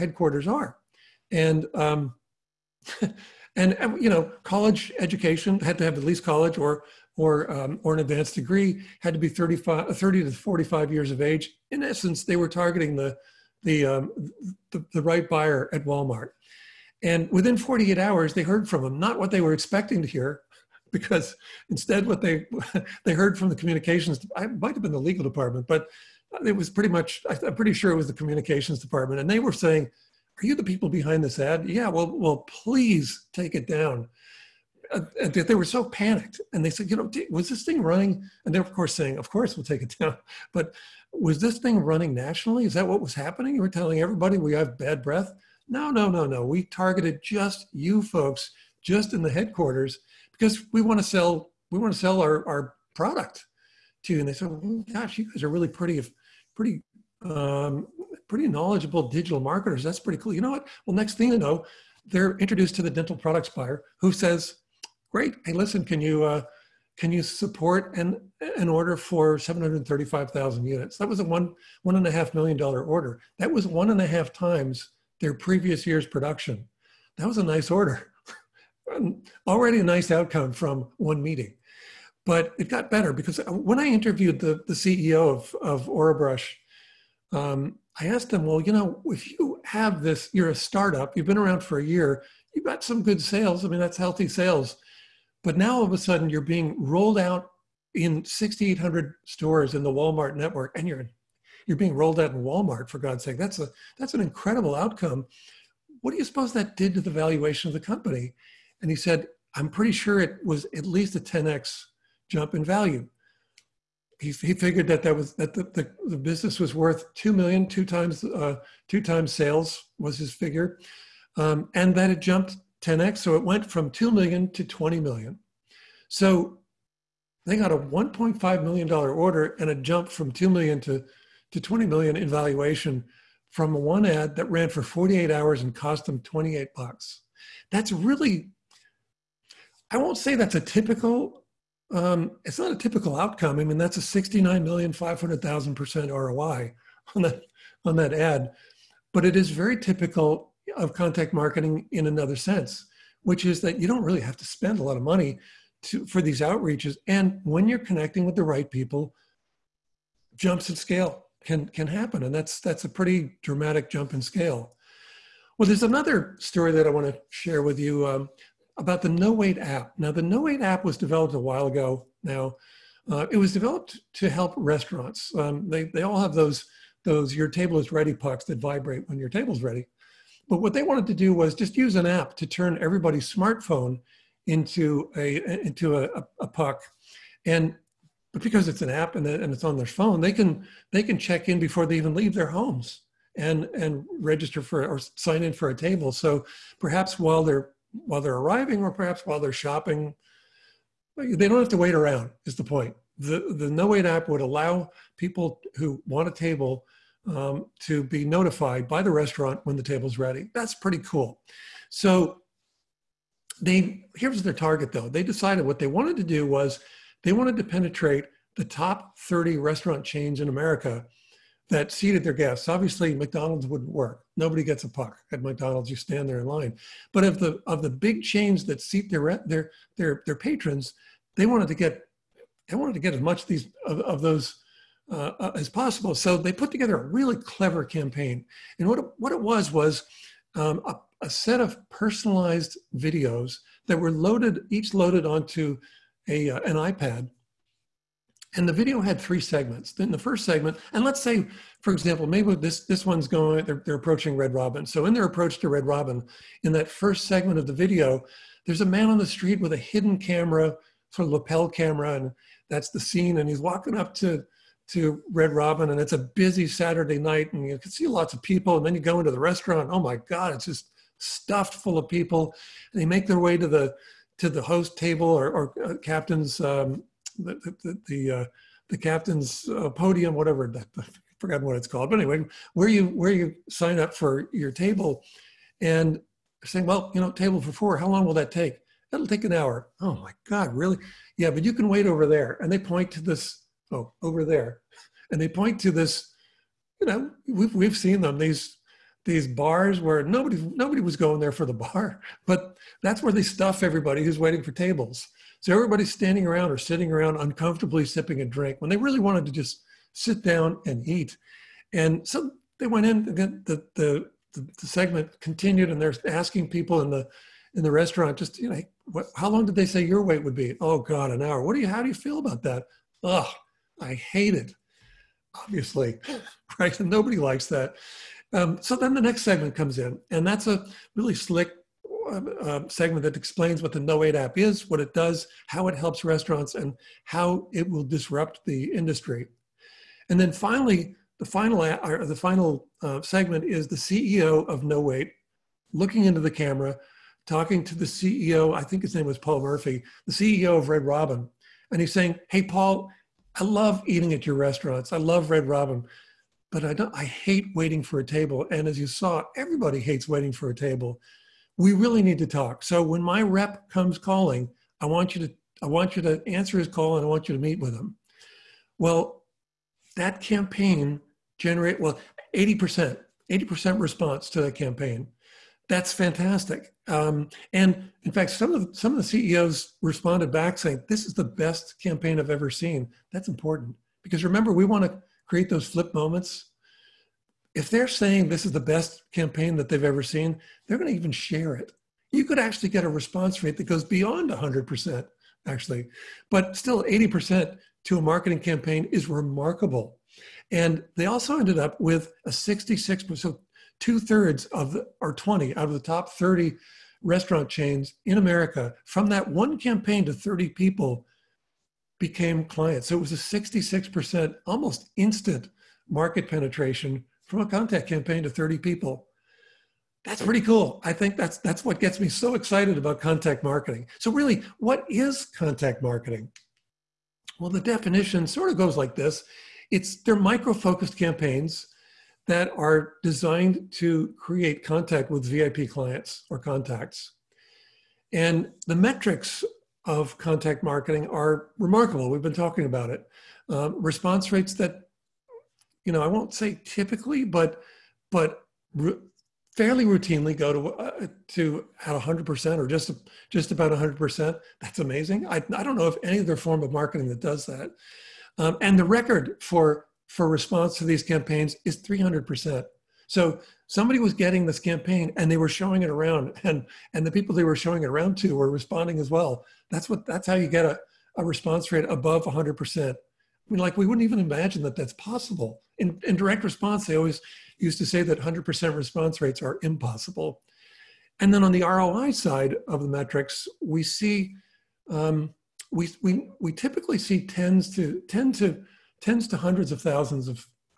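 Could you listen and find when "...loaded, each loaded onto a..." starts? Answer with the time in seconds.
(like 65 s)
244 s.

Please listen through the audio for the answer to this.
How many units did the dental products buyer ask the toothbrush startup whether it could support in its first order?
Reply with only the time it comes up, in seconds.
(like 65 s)
69 s.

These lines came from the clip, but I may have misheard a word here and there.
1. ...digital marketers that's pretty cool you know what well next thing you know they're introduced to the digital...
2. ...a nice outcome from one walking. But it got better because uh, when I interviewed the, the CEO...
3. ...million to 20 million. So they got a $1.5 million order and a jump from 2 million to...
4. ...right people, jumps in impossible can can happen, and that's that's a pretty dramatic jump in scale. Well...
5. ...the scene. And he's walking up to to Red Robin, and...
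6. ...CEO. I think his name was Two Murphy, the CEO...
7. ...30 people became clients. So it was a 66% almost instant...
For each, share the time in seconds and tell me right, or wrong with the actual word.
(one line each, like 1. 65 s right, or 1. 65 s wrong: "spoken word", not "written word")
1. 59 s wrong: "dental", not "digital"
2. 79 s wrong: "meeting", not "walking"
3. 124 s right
4. 158 s wrong: "scale", not "impossible"
5. 262 s right
6. 348 s wrong: "Paul", not "Two"
7. 410 s right.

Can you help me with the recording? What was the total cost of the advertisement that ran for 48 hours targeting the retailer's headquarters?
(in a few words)
$28.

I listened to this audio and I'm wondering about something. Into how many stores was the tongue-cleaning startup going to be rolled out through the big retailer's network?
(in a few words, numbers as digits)
6,800.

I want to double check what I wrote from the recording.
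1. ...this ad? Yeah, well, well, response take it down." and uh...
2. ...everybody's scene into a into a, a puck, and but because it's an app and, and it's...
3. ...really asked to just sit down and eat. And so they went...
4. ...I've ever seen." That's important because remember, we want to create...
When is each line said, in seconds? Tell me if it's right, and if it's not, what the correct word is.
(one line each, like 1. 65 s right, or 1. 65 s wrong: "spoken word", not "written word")
1. 31 s wrong: "please", not "response"
2. 182 s wrong: "smartphone", not "scene"
3. 308 s wrong: "wanted", not "asked"
4. 382 s right.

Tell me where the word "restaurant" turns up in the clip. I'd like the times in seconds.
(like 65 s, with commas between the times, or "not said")
174 s, 209 s, 219 s, 269 s, 317 s, 336 s, 354 s, 407 s.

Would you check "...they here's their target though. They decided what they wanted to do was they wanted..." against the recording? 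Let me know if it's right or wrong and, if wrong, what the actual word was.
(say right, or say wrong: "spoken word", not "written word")
right.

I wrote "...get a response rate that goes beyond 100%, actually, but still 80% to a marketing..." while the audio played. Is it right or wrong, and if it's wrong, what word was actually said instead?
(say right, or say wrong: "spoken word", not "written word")
right.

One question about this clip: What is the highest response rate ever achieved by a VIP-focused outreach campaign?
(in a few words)
300%.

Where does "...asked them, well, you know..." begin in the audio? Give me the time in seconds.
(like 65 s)
88 s.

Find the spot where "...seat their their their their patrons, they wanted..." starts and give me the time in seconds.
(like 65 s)
228 s.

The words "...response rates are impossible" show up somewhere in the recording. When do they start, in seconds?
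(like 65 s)
478 s.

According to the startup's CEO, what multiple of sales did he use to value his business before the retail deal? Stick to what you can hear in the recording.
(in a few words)
2 times sales.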